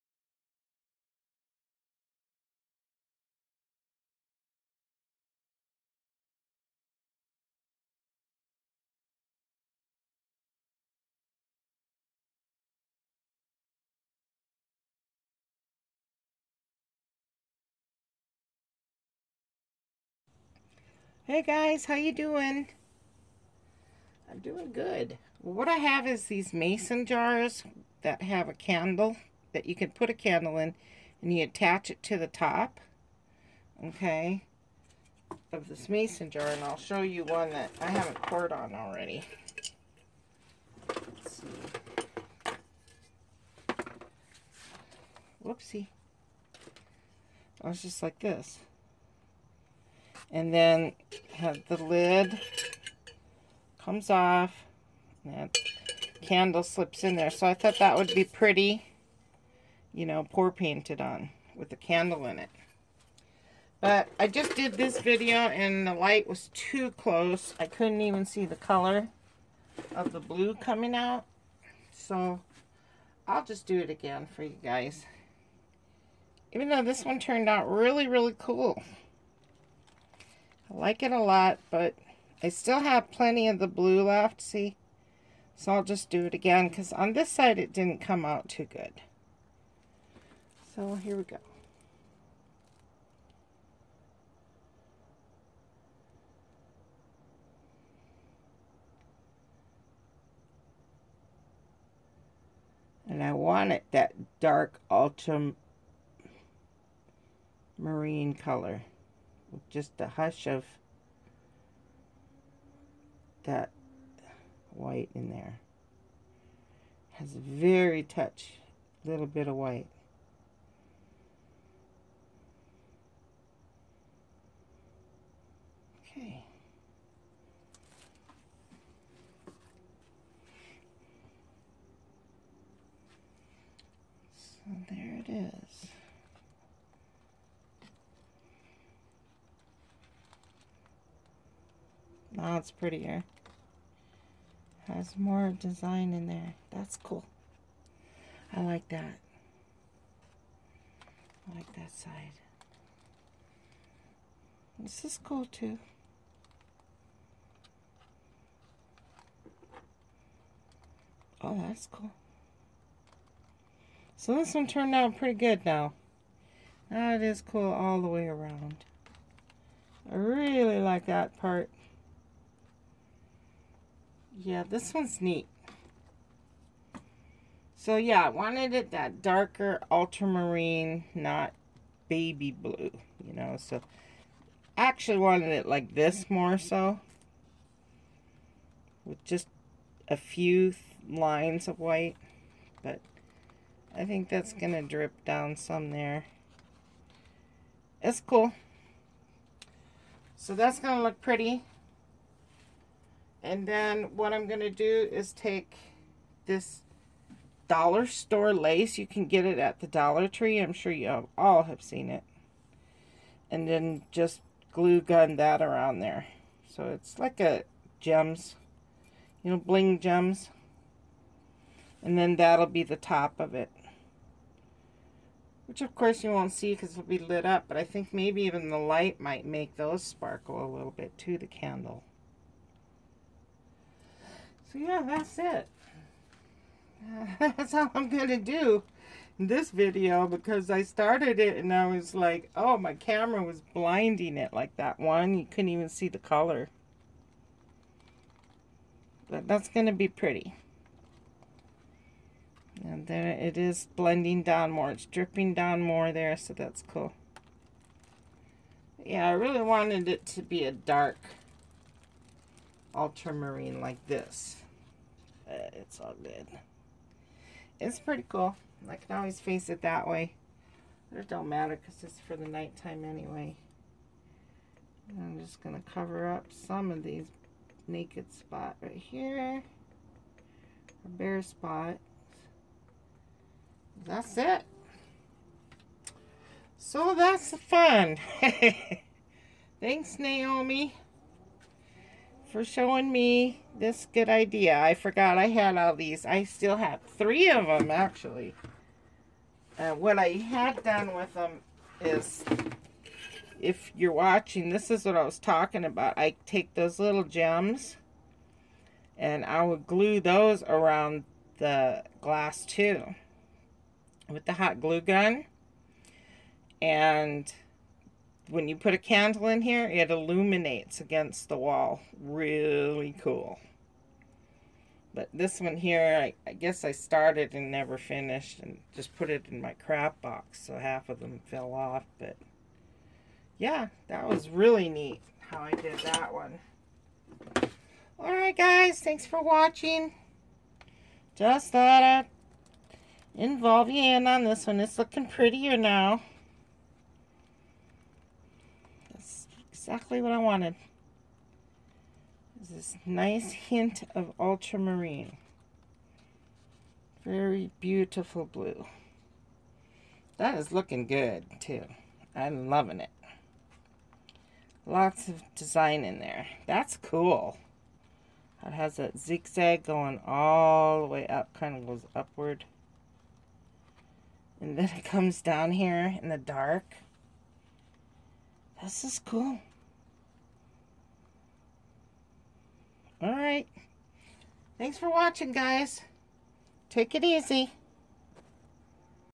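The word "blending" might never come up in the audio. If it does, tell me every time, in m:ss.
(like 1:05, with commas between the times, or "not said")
4:13.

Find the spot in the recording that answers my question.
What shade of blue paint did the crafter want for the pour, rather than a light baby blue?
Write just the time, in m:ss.
1:44.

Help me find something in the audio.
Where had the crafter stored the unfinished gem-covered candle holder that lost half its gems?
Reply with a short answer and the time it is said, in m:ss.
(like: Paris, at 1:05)
crap box, at 5:29.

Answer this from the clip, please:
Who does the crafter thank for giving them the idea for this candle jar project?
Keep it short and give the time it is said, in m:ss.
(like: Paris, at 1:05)
Naomi, at 4:50.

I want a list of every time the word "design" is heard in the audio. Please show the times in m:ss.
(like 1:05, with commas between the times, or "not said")
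2:25, 6:05.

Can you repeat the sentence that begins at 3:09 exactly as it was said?
With just a few lines of white, but I think that's going to drip down some there.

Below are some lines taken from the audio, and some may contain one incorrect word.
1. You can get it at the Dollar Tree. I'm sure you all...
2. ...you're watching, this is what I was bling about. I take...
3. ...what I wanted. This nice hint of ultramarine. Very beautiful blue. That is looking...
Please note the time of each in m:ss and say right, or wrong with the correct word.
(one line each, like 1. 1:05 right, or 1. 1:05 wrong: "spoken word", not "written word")
1. 3:28 right
2. 5:03 wrong: "talking", not "bling"
3. 5:50 right.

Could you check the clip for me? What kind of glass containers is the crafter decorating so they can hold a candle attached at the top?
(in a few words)
mason jars.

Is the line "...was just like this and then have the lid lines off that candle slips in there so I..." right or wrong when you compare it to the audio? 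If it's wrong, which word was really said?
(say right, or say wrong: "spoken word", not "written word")
wrong: "comes", not "lines".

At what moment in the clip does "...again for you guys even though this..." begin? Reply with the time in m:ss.
1:13.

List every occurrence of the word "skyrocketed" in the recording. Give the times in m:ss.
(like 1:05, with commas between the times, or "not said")
not said.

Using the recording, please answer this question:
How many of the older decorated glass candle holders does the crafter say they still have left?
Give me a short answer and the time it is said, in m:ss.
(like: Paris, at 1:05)
3, at 4:57.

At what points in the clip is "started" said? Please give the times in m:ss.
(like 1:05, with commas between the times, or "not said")
4:00, 5:26.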